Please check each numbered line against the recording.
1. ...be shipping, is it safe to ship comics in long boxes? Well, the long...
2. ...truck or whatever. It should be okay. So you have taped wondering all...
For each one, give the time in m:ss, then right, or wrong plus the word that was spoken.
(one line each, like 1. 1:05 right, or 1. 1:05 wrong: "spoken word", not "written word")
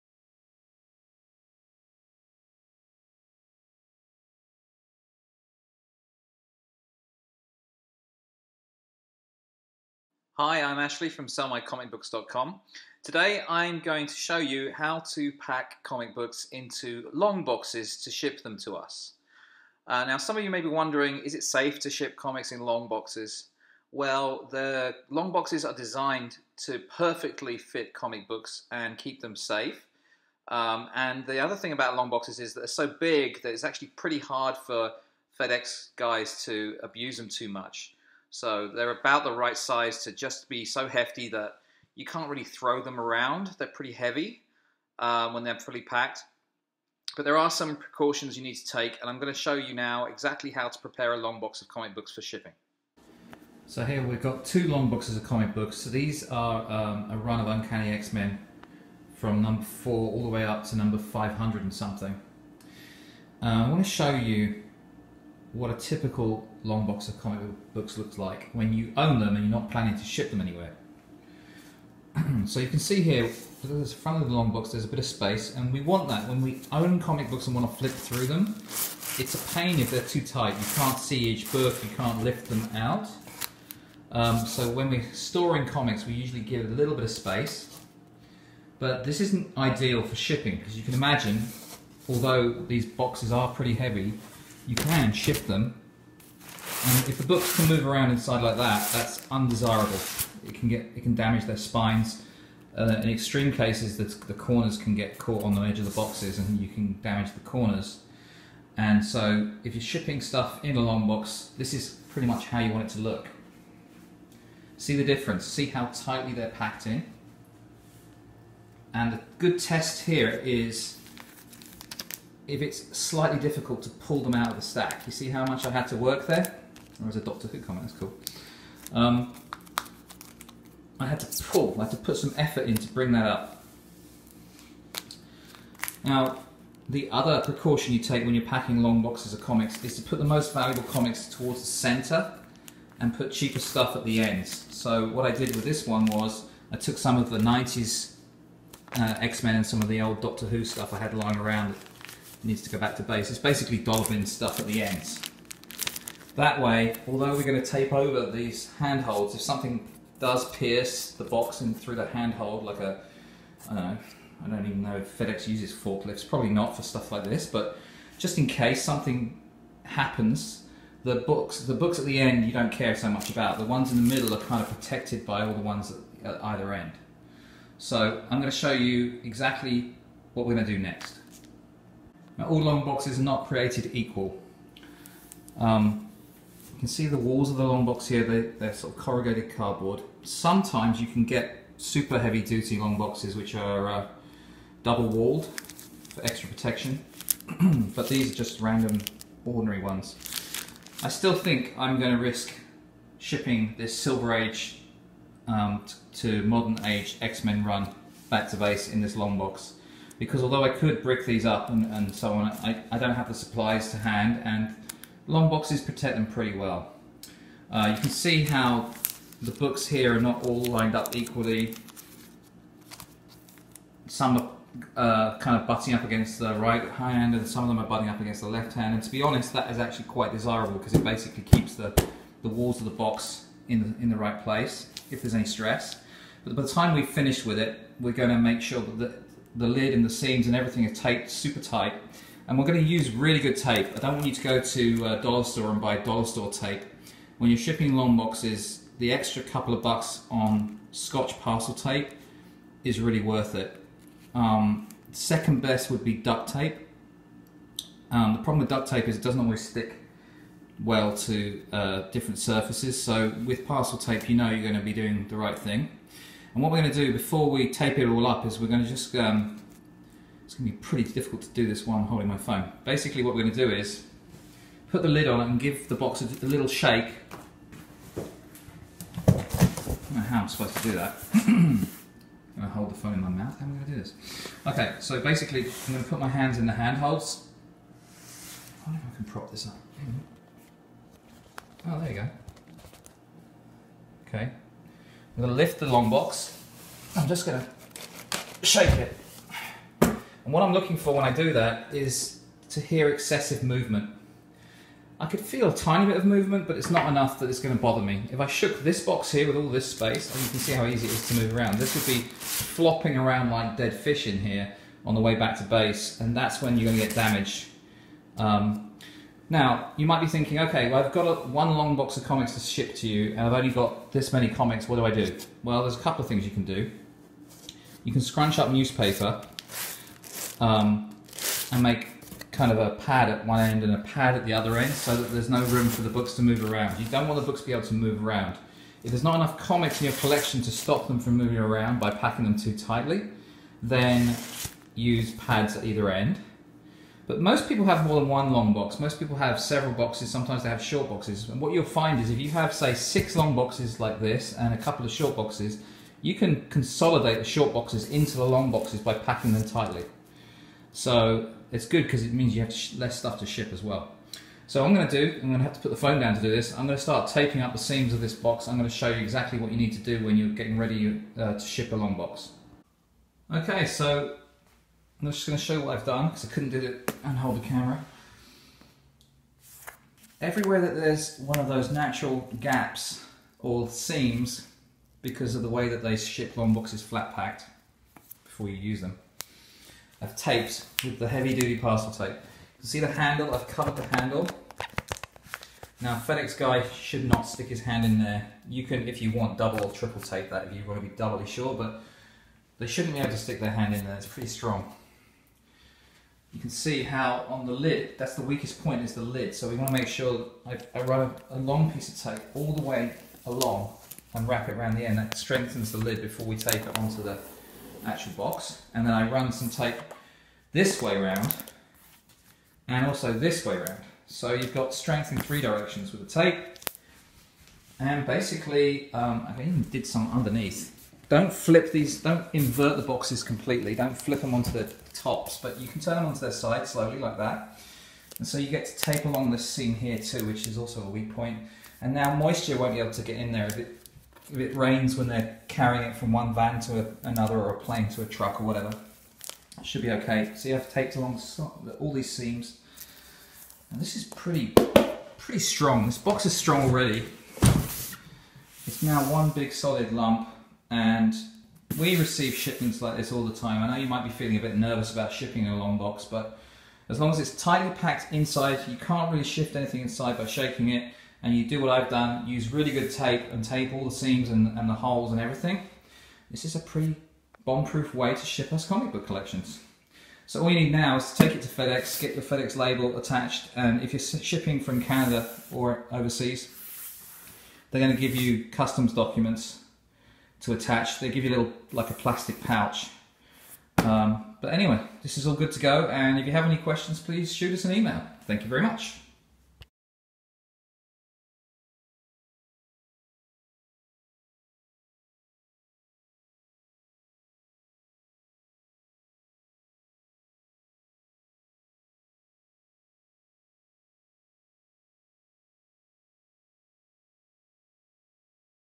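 1. 0:20 wrong: "wondering", not "shipping"
2. 7:28 wrong: "along", not "wondering".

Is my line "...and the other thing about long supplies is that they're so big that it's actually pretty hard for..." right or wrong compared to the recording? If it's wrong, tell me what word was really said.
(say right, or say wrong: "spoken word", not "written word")
wrong: "boxes", not "supplies".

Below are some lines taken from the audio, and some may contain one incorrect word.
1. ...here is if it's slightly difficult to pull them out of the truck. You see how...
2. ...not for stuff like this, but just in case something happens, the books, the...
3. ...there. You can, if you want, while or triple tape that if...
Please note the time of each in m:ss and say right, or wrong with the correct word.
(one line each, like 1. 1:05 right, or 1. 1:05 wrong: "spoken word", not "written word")
1. 2:00 wrong: "stack", not "truck"
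2. 2:46 right
3. 6:38 wrong: "double", not "while".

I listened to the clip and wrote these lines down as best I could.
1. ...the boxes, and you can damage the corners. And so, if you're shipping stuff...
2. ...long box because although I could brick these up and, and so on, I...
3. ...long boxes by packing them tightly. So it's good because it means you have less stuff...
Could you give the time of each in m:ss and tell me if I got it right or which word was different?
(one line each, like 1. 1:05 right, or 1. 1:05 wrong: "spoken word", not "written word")
1. 1:45 right
2. 3:29 right
3. 5:58 right.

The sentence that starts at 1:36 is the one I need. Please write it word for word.
And if the books can move around inside like that, that's undesirable.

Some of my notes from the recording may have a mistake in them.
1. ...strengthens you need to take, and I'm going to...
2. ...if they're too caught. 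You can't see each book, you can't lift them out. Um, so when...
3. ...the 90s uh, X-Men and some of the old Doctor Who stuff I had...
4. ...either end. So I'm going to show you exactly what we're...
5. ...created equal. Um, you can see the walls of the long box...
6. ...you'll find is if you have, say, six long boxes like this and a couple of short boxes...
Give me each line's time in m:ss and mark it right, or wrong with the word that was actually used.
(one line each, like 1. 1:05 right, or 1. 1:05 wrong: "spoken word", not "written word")
1. 0:47 wrong: "precautions", not "strengthens"
2. 1:19 wrong: "tight", not "caught"
3. 2:27 right
4. 2:56 right
5. 3:03 right
6. 5:51 right.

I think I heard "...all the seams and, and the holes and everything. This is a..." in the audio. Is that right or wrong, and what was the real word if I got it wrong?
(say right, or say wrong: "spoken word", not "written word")
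right.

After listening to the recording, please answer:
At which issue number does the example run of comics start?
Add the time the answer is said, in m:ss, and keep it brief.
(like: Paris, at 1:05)
4, at 0:59.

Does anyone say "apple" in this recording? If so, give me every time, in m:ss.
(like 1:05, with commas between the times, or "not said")
not said.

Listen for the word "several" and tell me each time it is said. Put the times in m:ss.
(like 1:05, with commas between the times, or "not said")
5:49.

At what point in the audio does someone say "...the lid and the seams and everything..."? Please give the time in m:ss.
3:59.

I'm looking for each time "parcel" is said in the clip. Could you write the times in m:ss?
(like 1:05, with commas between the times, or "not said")
4:11, 4:23, 6:31.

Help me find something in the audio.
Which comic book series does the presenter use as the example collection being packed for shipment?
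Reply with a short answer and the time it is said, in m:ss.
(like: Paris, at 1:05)
Uncanny X-Men, at 0:57.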